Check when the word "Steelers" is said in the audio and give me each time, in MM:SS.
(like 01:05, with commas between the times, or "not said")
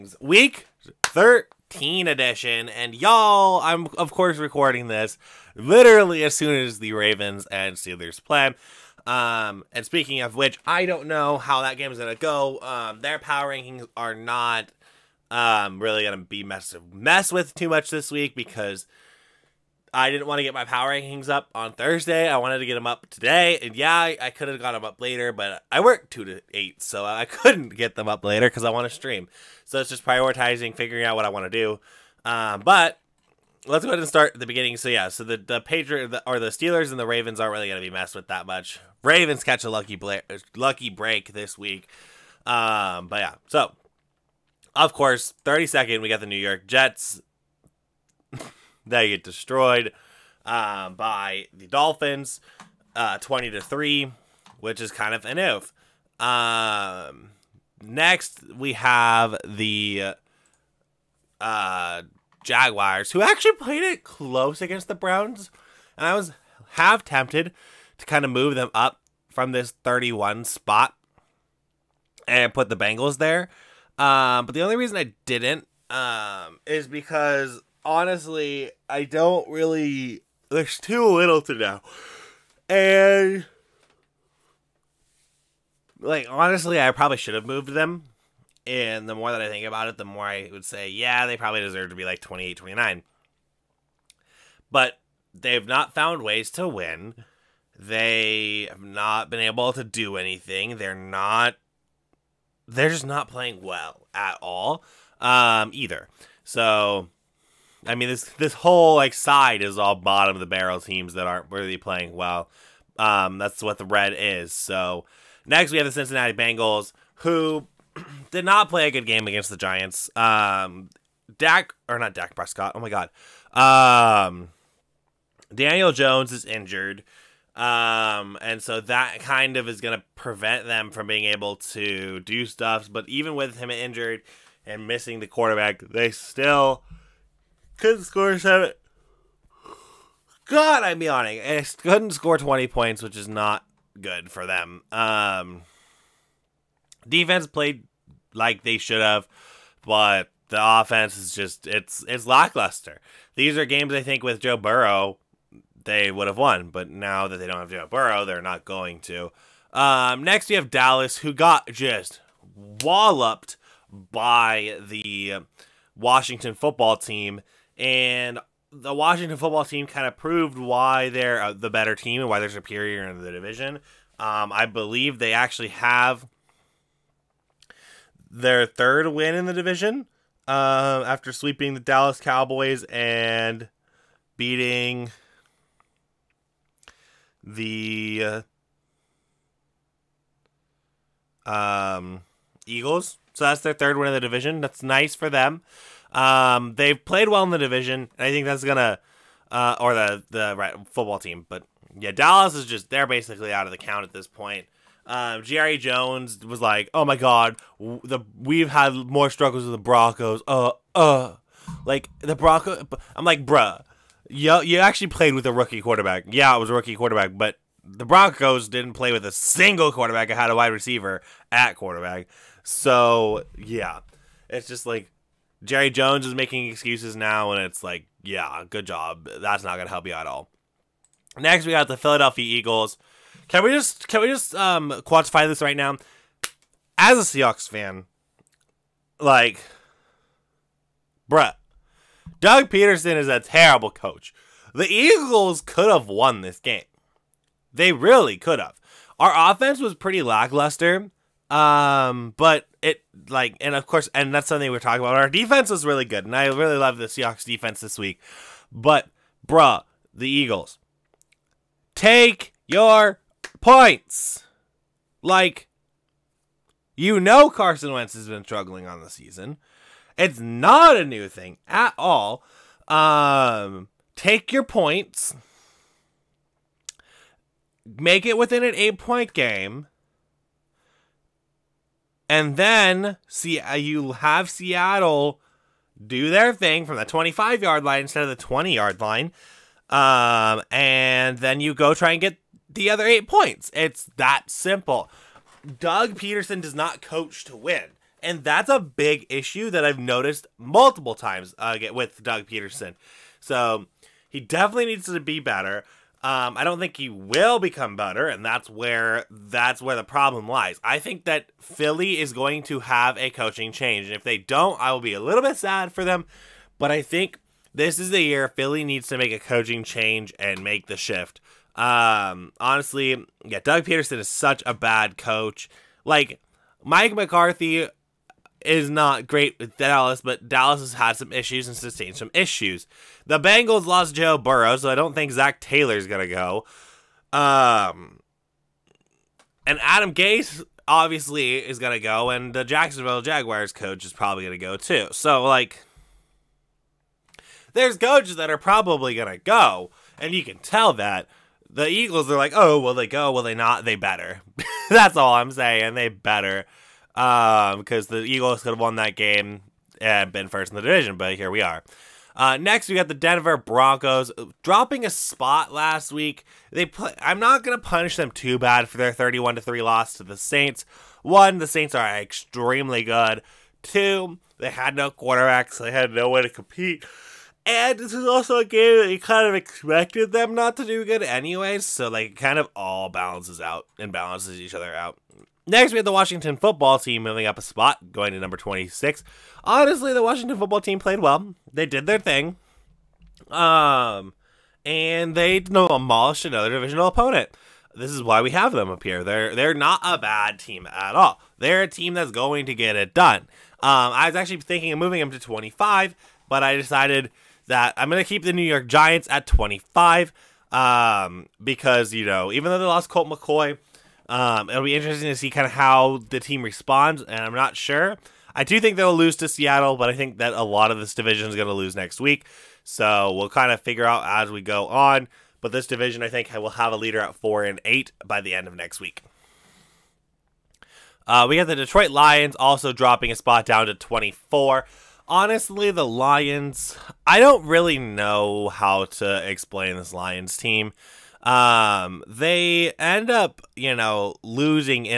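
00:07, 00:36.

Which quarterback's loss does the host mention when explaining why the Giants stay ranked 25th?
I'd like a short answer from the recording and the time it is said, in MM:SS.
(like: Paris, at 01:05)
Colt McCoy, at 06:53.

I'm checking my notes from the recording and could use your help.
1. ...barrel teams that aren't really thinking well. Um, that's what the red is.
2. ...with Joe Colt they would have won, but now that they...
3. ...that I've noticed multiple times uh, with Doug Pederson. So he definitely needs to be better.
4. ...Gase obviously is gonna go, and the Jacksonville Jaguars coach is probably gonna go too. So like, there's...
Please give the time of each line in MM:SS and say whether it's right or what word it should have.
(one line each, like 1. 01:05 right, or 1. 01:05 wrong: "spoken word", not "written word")
1. 01:50 wrong: "playing", not "thinking"
2. 02:34 wrong: "Burrow", not "Colt"
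3. 04:59 right
4. 05:40 right.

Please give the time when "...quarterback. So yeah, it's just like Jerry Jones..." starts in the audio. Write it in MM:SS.
03:41.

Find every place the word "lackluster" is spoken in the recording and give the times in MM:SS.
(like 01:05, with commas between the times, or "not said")
02:32, 04:10.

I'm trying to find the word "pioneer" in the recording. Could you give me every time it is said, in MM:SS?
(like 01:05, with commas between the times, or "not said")
not said.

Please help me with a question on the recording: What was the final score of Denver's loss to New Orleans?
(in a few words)
31 to 3.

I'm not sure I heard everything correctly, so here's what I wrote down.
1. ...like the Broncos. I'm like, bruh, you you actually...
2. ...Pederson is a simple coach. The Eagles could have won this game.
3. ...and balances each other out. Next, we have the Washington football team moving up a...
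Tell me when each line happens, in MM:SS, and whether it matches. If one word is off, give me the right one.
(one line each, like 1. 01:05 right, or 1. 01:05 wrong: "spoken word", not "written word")
1. 03:31 right
2. 04:02 wrong: "terrible", not "simple"
3. 06:23 right.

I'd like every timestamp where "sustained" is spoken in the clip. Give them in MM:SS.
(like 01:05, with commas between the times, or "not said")
05:31.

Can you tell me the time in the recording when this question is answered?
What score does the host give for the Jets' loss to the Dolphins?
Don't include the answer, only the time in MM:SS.
00:53.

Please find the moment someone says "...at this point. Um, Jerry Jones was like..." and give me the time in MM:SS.
03:24.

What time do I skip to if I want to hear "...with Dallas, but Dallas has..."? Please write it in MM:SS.
05:29.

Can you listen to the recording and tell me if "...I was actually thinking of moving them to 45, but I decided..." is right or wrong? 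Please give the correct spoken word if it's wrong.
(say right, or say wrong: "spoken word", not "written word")
wrong: "25", not "45".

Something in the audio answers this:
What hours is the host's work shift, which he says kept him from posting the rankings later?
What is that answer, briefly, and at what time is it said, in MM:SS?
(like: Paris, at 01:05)
2 to 8, at 00:26.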